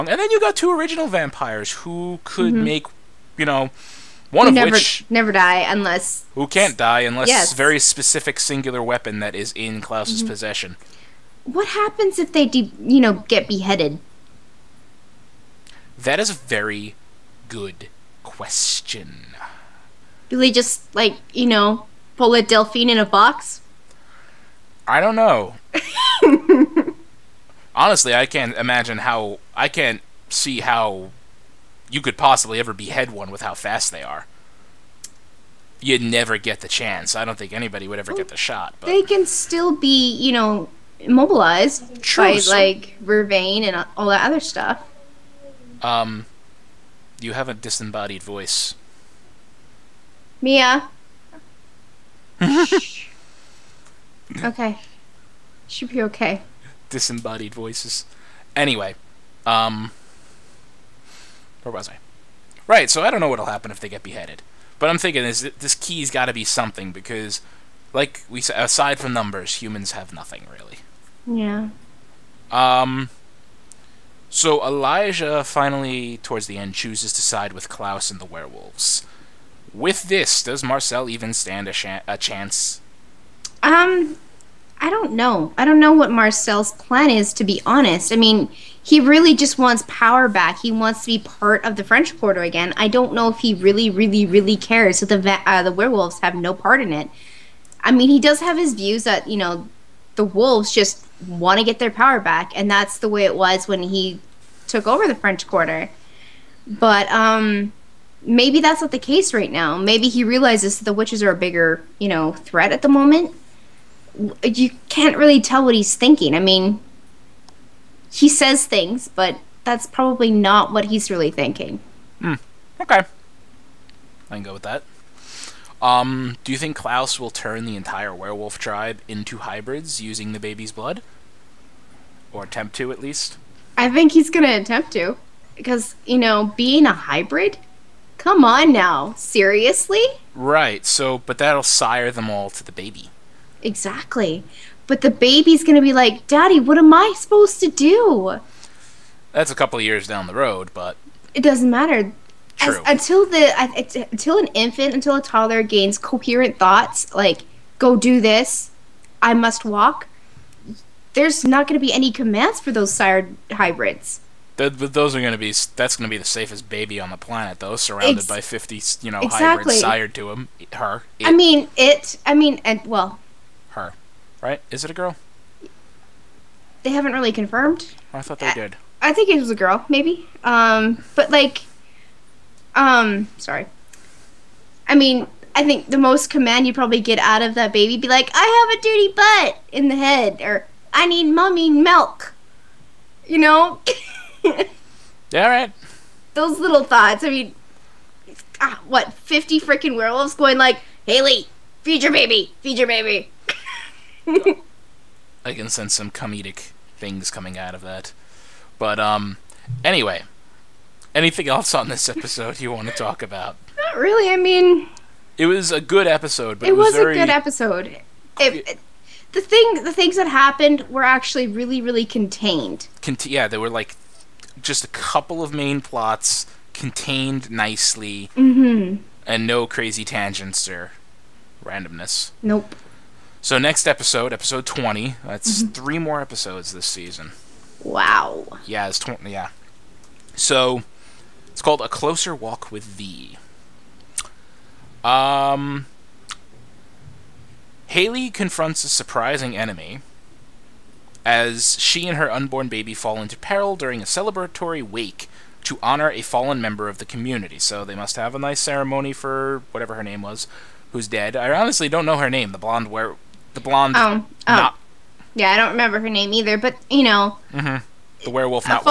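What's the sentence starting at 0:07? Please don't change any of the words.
very specific singular weapon that is in Klaus's mm-hmm.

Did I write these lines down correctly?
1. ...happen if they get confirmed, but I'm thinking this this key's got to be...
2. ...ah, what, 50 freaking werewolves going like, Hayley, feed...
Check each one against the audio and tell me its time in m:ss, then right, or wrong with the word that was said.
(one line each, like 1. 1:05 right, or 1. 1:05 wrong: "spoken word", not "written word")
1. 1:03 wrong: "beheaded", not "confirmed"
2. 3:18 right.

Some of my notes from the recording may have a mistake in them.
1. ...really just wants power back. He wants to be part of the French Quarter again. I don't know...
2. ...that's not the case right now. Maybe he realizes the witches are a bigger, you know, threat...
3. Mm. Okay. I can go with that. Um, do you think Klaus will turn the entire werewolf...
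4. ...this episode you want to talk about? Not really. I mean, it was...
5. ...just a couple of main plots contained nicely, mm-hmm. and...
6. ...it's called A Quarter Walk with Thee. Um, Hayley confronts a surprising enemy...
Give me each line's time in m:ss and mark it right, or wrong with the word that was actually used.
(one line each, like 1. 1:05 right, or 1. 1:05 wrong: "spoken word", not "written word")
1. 1:29 right
2. 1:48 right
3. 2:02 right
4. 3:31 right
5. 3:44 right
6. 4:01 wrong: "Closer", not "Quarter".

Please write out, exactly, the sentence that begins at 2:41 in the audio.
There's not going to be any commands for those sired hybrids.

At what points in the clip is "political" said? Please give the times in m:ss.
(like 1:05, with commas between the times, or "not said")
not said.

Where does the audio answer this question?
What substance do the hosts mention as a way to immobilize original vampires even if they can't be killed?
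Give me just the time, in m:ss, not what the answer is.
0:43.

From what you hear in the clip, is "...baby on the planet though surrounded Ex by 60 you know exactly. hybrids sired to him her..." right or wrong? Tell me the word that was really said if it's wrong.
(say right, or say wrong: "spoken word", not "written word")
wrong: "50", not "60".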